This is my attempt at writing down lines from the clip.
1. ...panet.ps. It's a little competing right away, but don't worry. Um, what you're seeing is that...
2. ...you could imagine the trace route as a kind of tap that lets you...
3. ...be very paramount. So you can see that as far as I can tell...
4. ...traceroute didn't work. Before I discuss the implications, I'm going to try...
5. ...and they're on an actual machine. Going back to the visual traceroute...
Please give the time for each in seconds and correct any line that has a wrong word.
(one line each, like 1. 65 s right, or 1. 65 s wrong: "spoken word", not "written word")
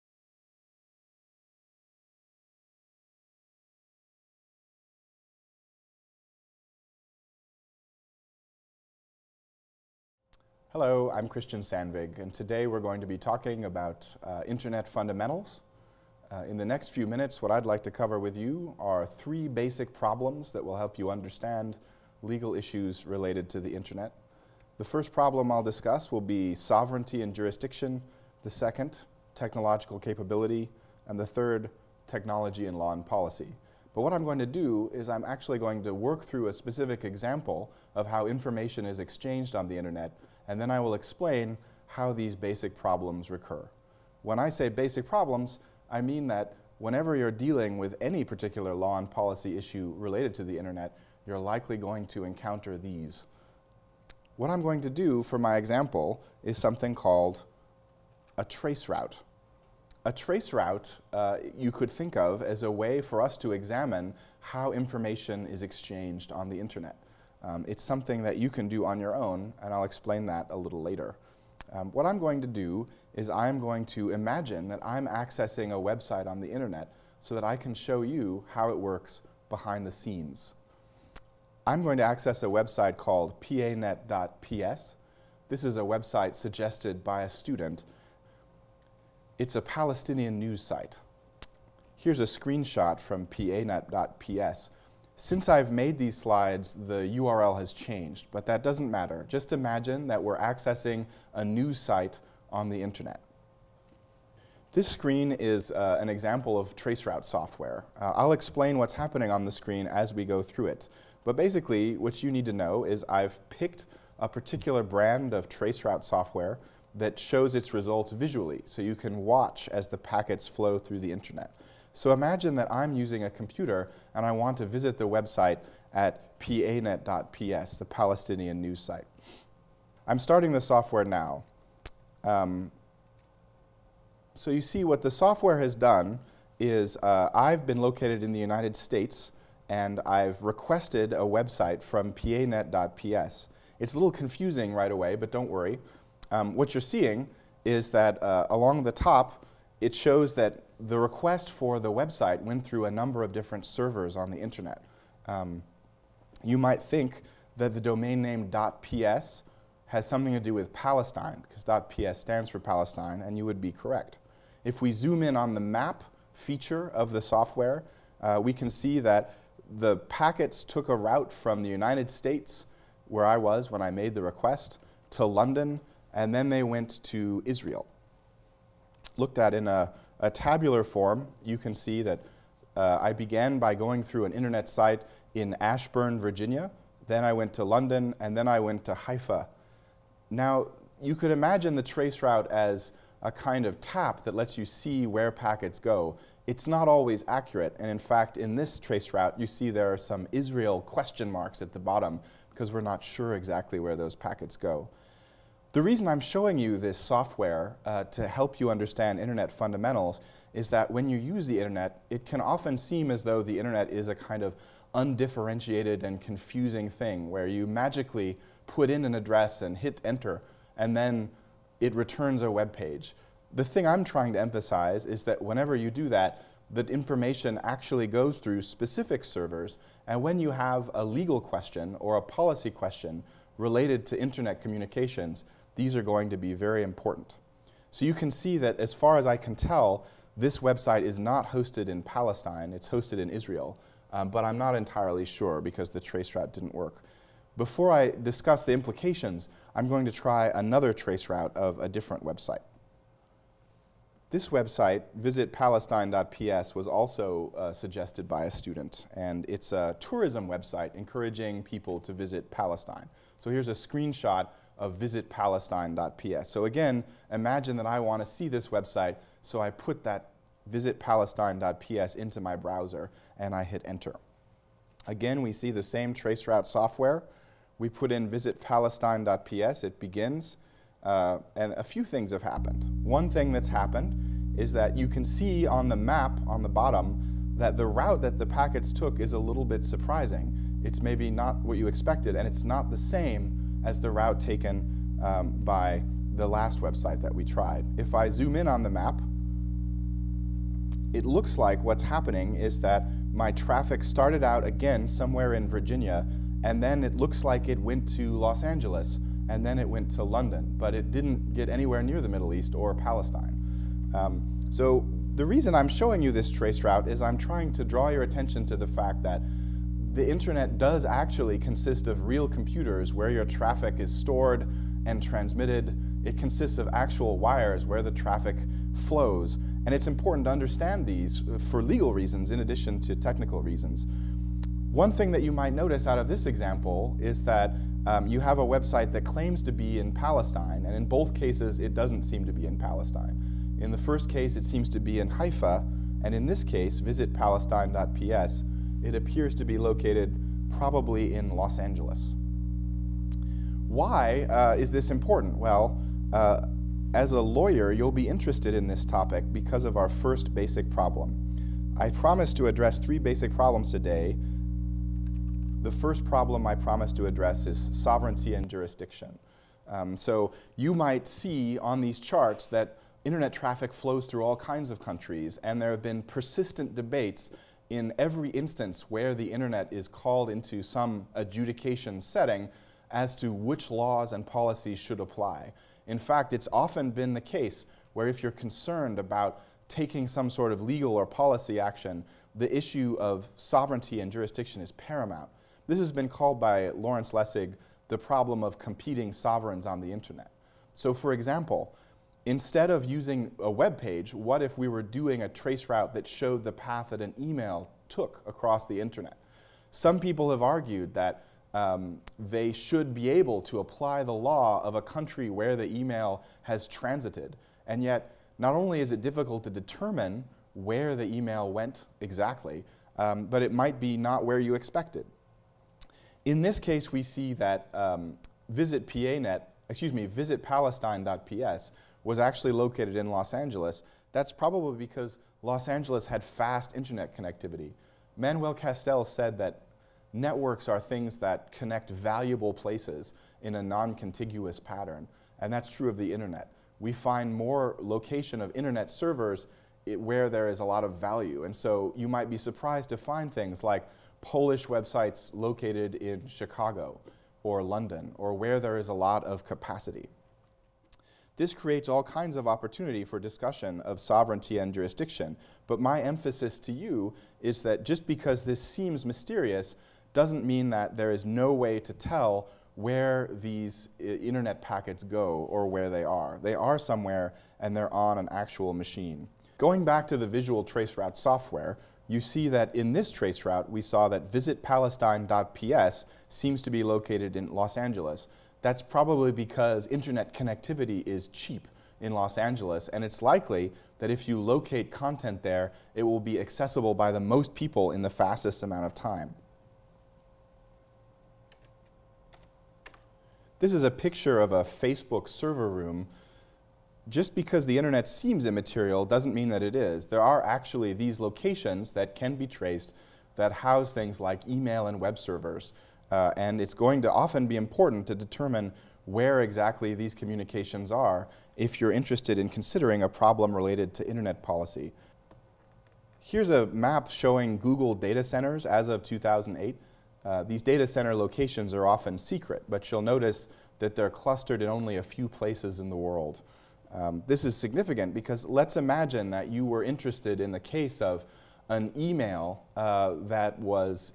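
1. 142 s wrong: "confusing", not "competing"
2. 191 s right
3. 236 s wrong: "important", not "paramount"
4. 246 s wrong: "route", not "traceroute"
5. 477 s right.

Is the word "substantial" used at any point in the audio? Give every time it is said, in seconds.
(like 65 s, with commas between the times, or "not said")
not said.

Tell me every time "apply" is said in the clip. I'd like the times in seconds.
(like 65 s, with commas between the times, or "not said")
385 s, 413 s.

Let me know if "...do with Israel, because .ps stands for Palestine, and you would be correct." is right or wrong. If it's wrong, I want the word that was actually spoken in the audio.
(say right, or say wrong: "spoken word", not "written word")
wrong: "Palestine", not "Israel".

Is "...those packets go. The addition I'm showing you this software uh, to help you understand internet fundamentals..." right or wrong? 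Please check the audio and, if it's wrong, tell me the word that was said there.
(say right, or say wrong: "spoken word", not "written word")
wrong: "reason", not "addition".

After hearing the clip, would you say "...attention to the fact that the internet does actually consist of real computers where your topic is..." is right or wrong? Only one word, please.
wrong.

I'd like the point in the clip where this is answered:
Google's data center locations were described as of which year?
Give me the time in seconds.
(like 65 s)
529 s.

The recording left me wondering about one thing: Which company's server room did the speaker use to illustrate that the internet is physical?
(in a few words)
Facebook.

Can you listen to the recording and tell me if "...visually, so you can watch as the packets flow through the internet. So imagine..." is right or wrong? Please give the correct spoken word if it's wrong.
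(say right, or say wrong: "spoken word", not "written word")
right.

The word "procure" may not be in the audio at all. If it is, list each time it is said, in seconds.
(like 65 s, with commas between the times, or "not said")
not said.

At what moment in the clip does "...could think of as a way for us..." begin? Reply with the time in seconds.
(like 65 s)
61 s.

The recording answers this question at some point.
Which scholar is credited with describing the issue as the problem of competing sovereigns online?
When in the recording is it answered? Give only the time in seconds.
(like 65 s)
396 s.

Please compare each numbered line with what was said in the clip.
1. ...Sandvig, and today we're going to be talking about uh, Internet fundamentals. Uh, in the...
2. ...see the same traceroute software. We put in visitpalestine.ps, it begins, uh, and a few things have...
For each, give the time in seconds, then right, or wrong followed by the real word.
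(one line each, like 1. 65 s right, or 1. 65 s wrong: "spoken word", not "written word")
1. 11 s right
2. 275 s right.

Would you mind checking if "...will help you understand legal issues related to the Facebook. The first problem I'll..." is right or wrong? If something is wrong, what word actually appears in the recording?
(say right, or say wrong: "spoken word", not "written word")
wrong: "Internet", not "Facebook".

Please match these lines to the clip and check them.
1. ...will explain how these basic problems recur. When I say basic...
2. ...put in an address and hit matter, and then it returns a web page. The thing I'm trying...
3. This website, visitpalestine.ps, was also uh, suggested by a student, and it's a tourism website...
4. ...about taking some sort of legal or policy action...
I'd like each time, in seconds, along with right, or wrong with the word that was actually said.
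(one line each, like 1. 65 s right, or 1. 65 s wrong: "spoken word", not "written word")
1. 40 s right
2. 218 s wrong: "enter", not "matter"
3. 254 s right
4. 389 s right.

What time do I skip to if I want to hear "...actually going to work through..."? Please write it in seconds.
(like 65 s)
35 s.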